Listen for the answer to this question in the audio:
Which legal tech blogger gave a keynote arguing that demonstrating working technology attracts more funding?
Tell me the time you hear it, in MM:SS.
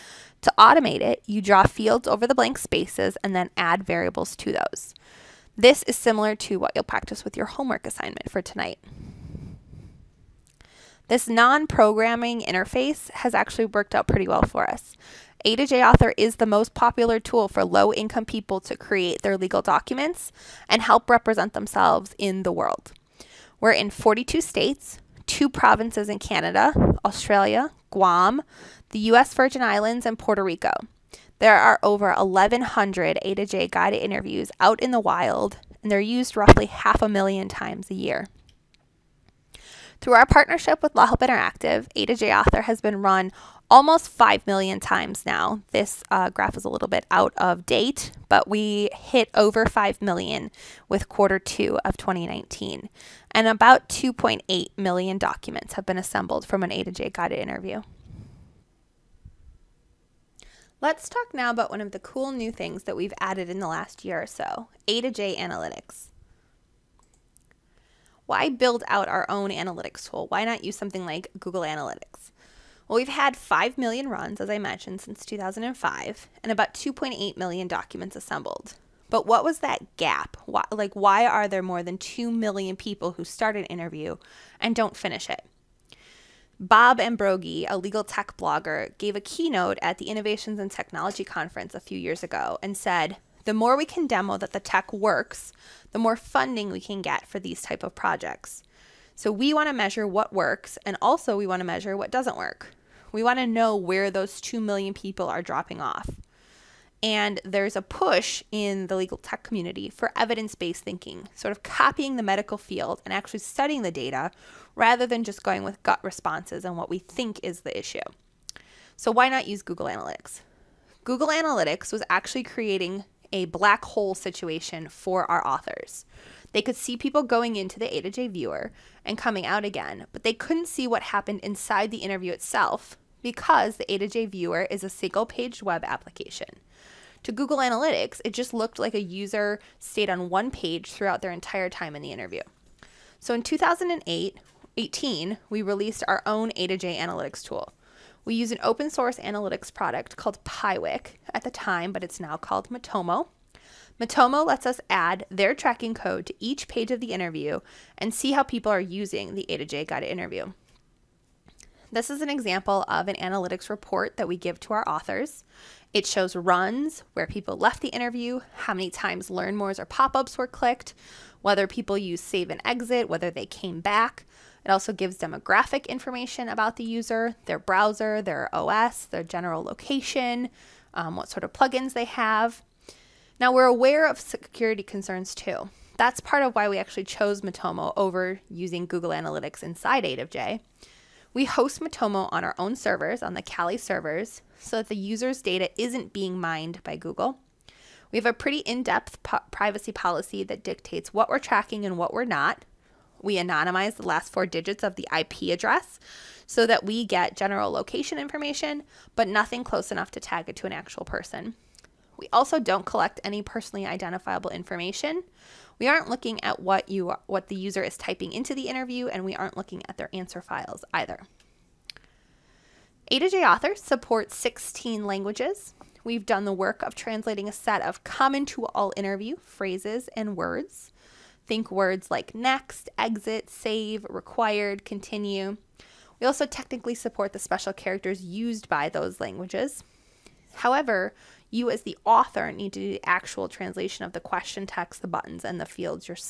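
01:26.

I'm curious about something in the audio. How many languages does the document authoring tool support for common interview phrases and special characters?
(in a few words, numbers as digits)
16.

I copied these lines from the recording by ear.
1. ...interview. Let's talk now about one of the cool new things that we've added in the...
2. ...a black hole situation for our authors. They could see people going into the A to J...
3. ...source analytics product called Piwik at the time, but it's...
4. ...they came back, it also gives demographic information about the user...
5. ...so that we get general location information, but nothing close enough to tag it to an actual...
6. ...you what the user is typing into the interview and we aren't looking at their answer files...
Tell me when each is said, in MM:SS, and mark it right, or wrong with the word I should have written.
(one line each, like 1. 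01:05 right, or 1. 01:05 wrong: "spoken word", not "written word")
1. 00:57 right
2. 02:03 right
3. 02:28 right
4. 02:53 right
5. 03:26 right
6. 03:36 right.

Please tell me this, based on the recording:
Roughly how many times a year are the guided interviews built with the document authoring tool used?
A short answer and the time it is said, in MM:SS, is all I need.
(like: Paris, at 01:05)
half a million, at 00:36.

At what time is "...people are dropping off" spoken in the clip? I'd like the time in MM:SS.
01:44.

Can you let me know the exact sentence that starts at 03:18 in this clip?
We have a pretty in depth po privacy policy that dictates what we're tracking and what we're not.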